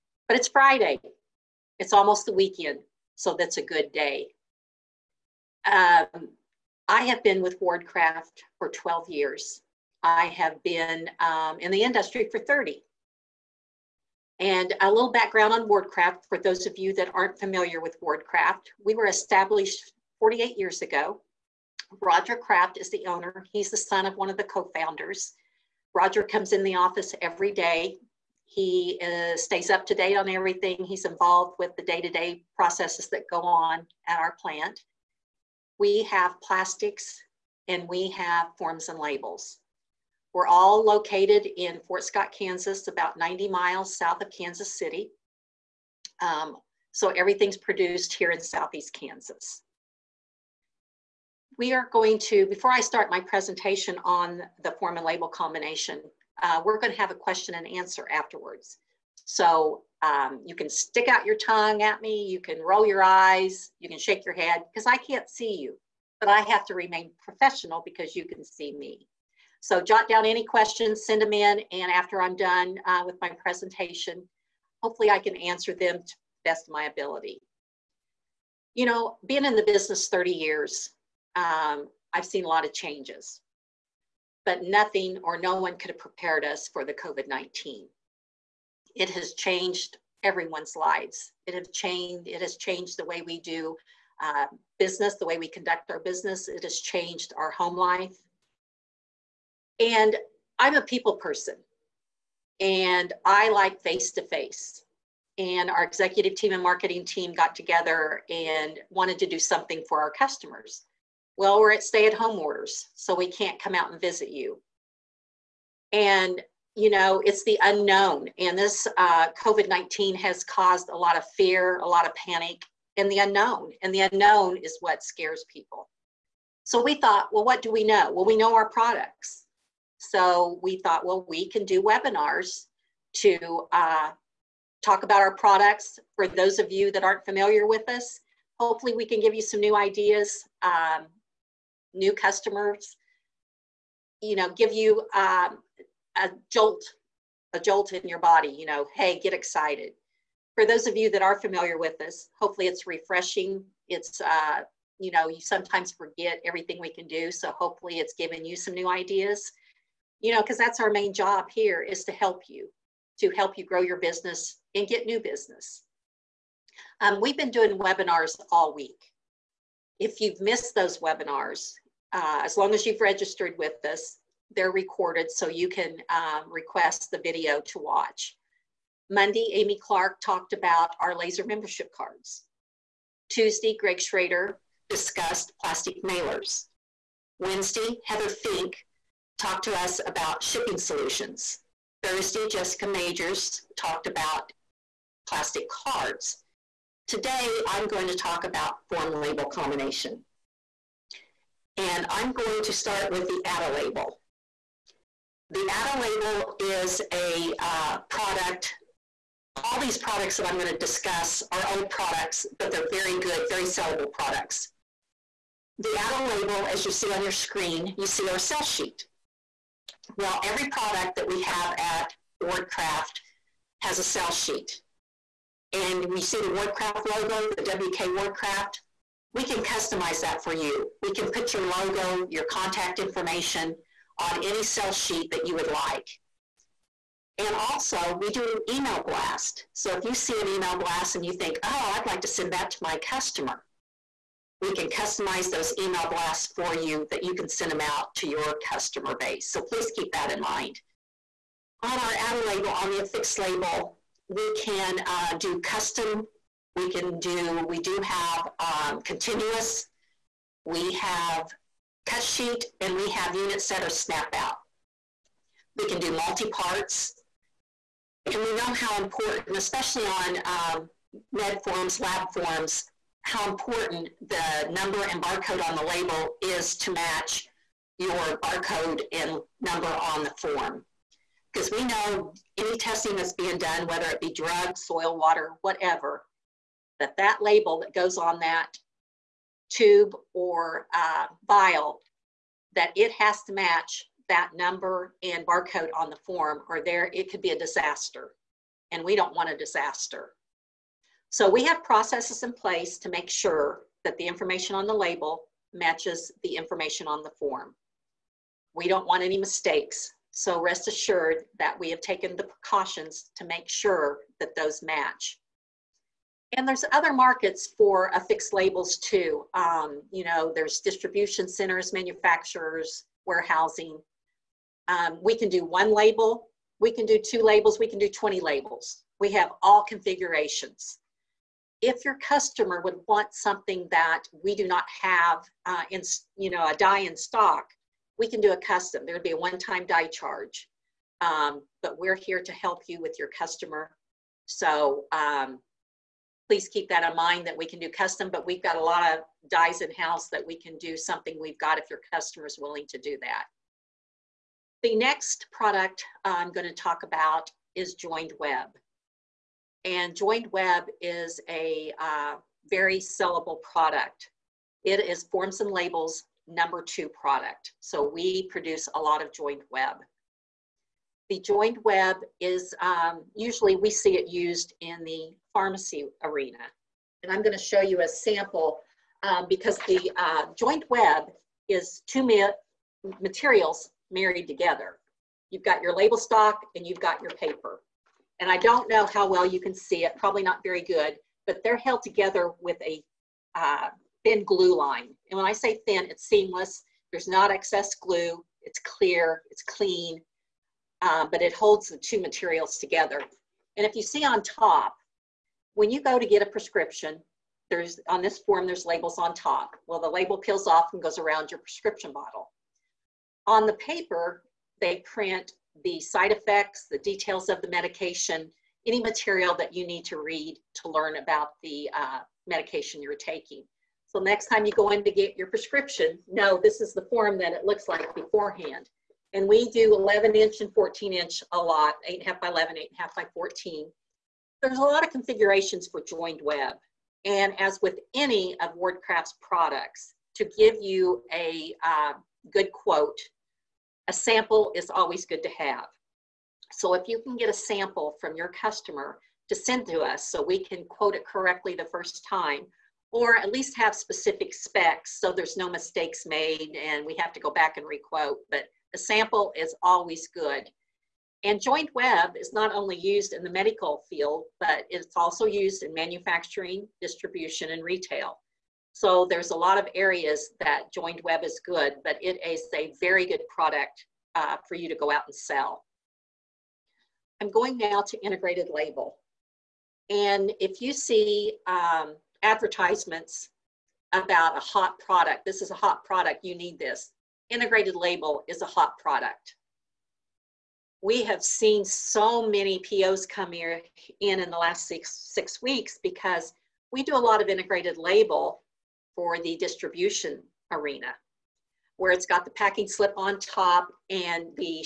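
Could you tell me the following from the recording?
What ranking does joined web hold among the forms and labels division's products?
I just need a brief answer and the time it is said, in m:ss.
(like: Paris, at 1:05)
number two, at 6:06.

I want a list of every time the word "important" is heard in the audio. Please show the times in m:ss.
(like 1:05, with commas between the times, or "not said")
4:29, 4:33.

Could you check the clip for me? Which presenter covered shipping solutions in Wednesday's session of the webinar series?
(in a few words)
Heather Fink.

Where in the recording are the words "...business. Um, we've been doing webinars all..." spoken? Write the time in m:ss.
2:45.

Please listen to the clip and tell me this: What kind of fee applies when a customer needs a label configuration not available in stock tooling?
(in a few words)
one-time die charge.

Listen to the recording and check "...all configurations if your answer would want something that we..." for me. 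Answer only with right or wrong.
wrong.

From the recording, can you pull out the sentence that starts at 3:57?
And also, we do email blast.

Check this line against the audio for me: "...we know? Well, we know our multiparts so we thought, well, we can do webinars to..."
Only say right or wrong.
wrong.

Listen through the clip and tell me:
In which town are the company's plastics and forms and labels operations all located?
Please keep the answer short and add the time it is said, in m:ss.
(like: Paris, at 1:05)
Fort Scott, Kansas, at 0:41.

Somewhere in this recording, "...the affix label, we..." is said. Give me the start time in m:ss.
4:12.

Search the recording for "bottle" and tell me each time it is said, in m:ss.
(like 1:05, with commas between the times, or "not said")
6:52.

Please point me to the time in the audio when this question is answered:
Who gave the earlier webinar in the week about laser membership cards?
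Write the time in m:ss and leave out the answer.
2:59.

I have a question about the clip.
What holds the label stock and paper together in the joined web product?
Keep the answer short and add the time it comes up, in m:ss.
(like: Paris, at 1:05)
thin glue line, at 6:34.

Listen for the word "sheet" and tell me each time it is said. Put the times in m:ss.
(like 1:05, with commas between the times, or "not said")
3:38, 3:44, 3:54, 4:22.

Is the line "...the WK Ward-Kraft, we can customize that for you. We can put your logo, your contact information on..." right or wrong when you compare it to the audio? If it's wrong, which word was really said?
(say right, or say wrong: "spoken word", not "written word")
right.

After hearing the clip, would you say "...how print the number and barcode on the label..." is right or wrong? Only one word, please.
wrong.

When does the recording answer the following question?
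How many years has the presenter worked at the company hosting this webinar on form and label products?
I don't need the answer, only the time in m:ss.
0:08.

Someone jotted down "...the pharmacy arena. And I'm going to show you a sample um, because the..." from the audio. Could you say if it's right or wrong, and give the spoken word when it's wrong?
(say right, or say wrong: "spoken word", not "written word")
right.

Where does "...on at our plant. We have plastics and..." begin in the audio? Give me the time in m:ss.
0:33.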